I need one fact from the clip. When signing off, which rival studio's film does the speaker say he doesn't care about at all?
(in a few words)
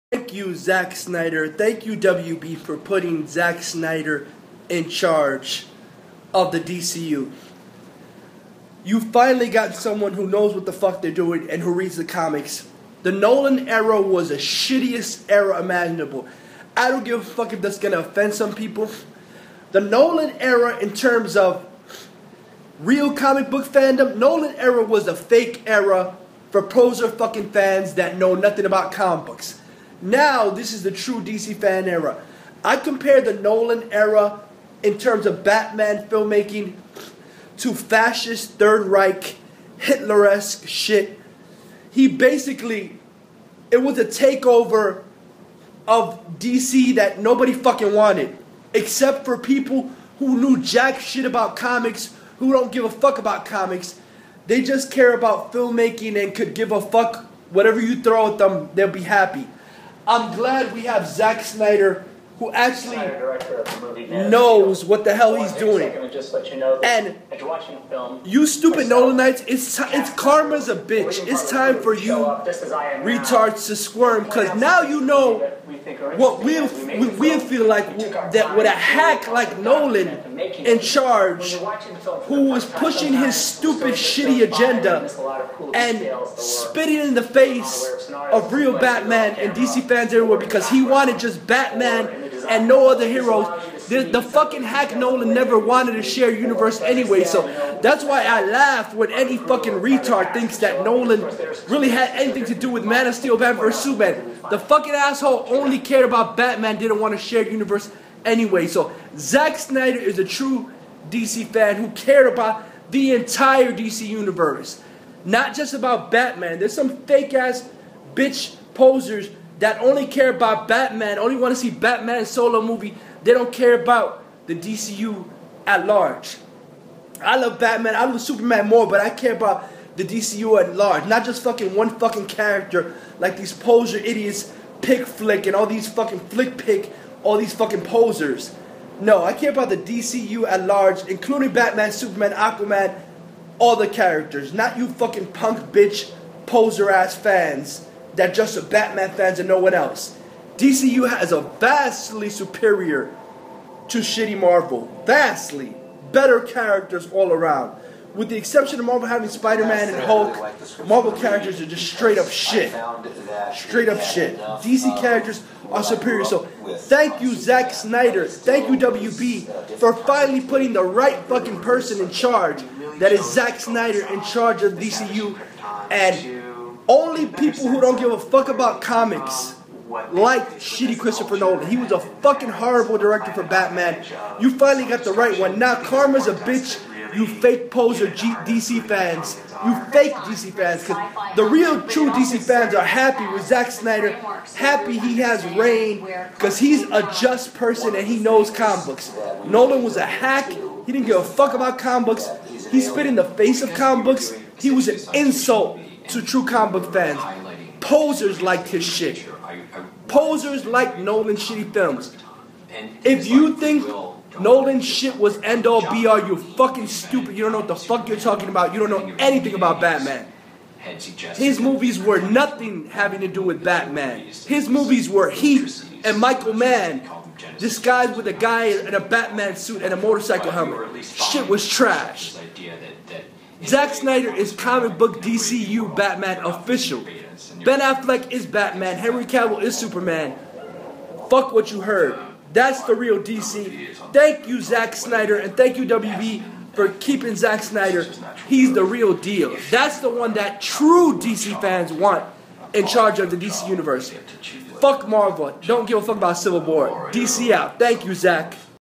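Civil War.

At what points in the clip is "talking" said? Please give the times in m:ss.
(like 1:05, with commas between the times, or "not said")
3:38.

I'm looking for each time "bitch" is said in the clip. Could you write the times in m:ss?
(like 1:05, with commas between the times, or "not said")
1:10, 1:58, 2:25, 3:06.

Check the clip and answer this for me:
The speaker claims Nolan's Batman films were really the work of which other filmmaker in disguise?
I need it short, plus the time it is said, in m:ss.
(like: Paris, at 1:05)
Michael Mann, at 3:46.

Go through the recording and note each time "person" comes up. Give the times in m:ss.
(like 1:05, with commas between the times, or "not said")
2:51, 3:17.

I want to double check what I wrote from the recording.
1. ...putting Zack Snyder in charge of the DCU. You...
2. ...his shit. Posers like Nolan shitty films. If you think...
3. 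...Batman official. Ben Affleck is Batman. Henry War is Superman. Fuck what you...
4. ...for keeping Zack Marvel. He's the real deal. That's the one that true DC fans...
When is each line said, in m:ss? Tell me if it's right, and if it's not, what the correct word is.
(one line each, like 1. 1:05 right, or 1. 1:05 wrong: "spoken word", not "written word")
1. 0:02 right
2. 3:28 right
3. 3:55 wrong: "Cavill", not "War"
4. 4:06 wrong: "Snyder", not "Marvel".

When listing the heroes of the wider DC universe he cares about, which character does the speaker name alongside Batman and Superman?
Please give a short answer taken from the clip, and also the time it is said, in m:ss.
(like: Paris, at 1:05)
Aquaman, at 2:22.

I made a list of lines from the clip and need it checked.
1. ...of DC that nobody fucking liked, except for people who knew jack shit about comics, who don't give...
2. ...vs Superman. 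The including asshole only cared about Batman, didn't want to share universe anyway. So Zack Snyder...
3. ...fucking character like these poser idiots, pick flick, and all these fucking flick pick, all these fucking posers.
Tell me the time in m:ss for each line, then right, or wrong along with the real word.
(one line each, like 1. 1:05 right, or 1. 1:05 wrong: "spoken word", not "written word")
1. 0:45 wrong: "wanted", not "liked"
2. 1:43 wrong: "fucking", not "including"
3. 2:11 right.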